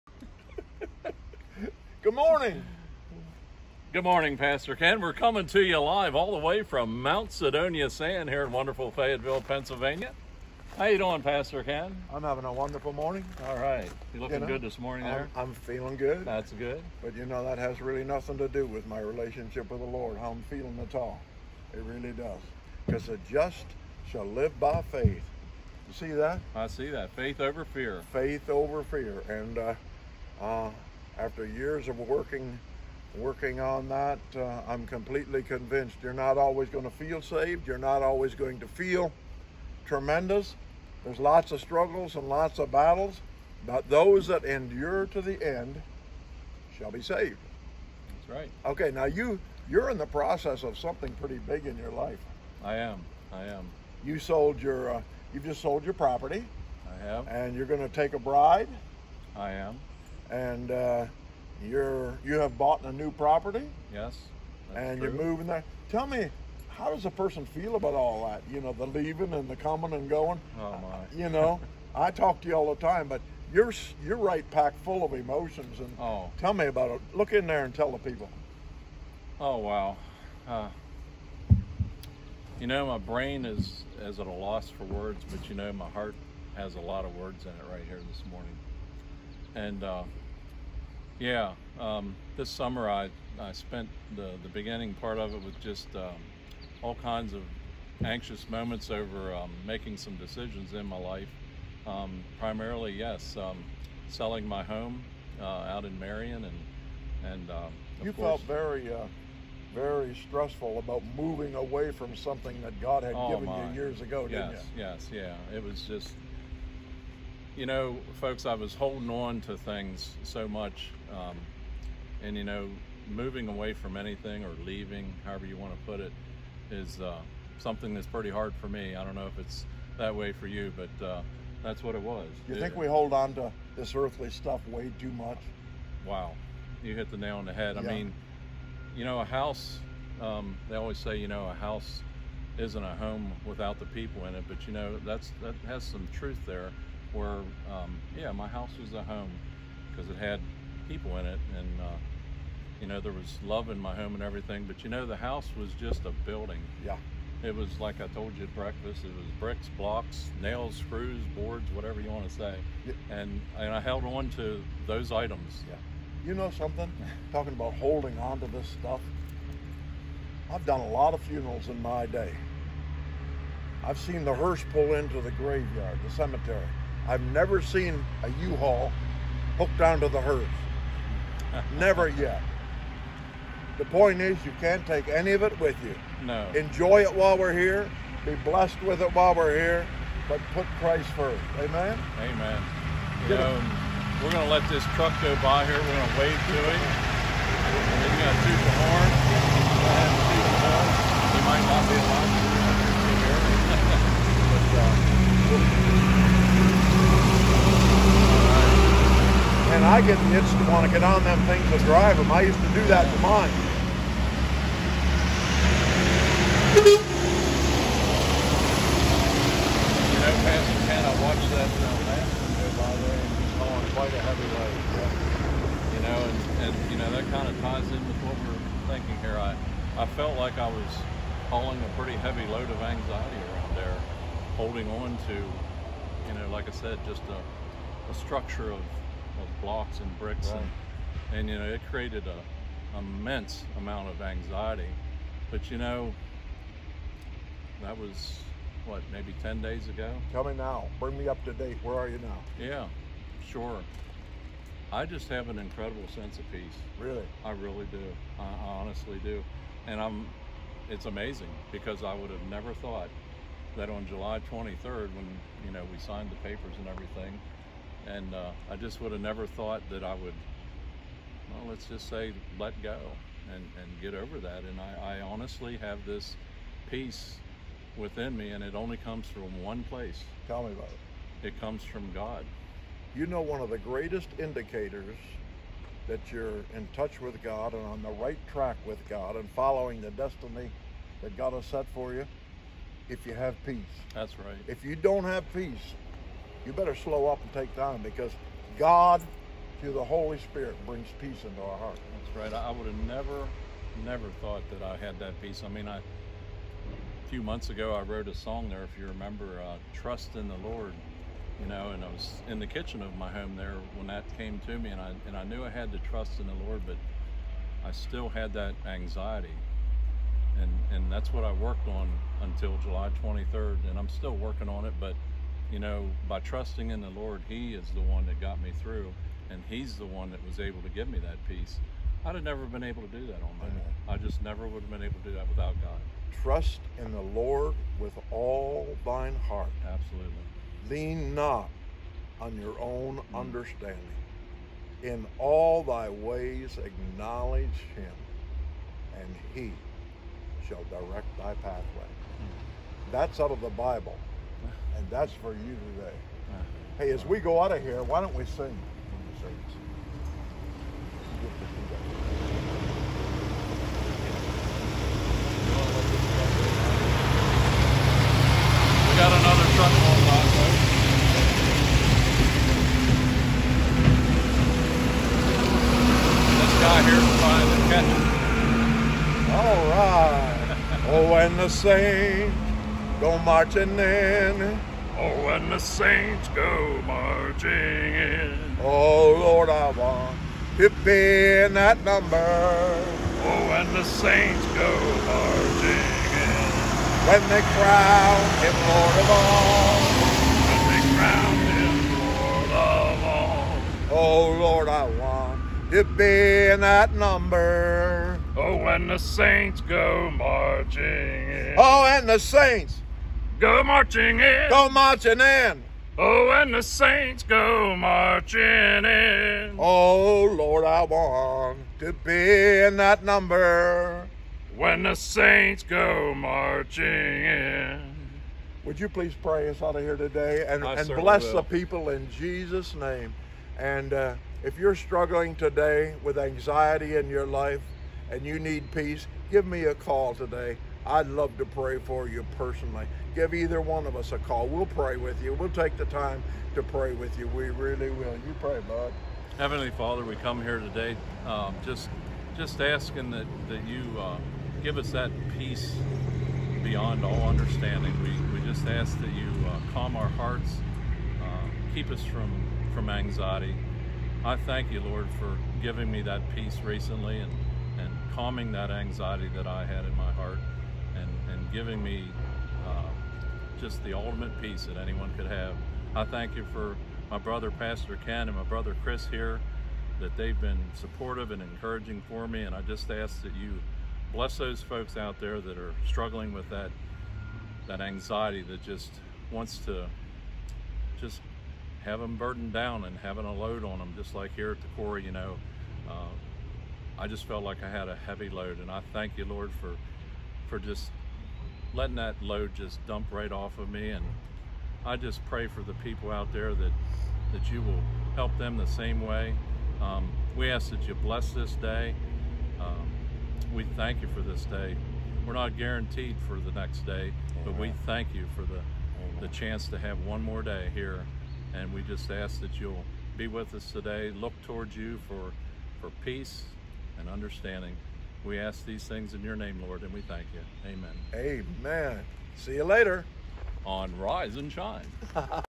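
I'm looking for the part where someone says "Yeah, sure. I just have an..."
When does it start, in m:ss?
4:12.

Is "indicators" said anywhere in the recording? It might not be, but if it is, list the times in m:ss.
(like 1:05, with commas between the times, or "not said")
4:44.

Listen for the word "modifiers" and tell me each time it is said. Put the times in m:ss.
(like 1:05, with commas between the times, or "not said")
not said.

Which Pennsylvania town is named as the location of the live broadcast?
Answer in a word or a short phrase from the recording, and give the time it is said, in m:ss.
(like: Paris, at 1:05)
Fayetteville, at 0:08.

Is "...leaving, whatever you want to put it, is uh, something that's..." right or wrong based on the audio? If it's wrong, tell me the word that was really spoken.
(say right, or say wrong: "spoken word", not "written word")
wrong: "however", not "whatever".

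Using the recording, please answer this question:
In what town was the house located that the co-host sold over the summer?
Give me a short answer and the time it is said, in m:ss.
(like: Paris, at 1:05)
Marion, at 1:45.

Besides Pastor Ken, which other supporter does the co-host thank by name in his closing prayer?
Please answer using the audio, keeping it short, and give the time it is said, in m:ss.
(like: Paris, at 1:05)
Chris, at 7:59.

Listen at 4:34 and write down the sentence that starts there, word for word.
And I, I honestly have this peace within me, and it only comes from one place.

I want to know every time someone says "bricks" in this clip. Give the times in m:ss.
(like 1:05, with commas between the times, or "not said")
2:39, 4:00.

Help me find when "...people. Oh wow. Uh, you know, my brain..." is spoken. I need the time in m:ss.
1:17.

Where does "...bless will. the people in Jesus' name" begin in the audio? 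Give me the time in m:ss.
7:11.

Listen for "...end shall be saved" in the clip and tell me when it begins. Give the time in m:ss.
0:45.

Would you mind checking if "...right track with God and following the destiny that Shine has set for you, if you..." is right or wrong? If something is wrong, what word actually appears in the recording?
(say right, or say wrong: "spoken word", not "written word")
wrong: "God", not "Shine".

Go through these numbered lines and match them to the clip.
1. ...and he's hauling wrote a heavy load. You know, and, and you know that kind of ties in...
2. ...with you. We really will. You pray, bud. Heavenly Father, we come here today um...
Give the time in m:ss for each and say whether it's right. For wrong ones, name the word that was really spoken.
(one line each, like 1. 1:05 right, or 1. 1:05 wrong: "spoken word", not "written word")
1. 3:43 wrong: "quite", not "wrote"
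2. 7:27 right.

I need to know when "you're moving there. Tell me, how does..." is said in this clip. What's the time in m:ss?
1:05.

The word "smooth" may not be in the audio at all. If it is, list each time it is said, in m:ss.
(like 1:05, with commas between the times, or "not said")
not said.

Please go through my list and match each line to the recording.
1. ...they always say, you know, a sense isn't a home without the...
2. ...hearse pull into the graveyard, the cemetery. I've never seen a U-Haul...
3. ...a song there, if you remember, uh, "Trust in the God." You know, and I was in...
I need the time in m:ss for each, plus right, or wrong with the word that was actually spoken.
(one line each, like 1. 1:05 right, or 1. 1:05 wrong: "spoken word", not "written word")
1. 2:20 wrong: "house", not "sense"
2. 2:54 right
3. 5:08 wrong: "Lord", not "God".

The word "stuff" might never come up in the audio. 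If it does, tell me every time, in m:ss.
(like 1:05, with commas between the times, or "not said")
2:14, 2:48.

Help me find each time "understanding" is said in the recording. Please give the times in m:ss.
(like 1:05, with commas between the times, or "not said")
5:43, 7:37, 8:47.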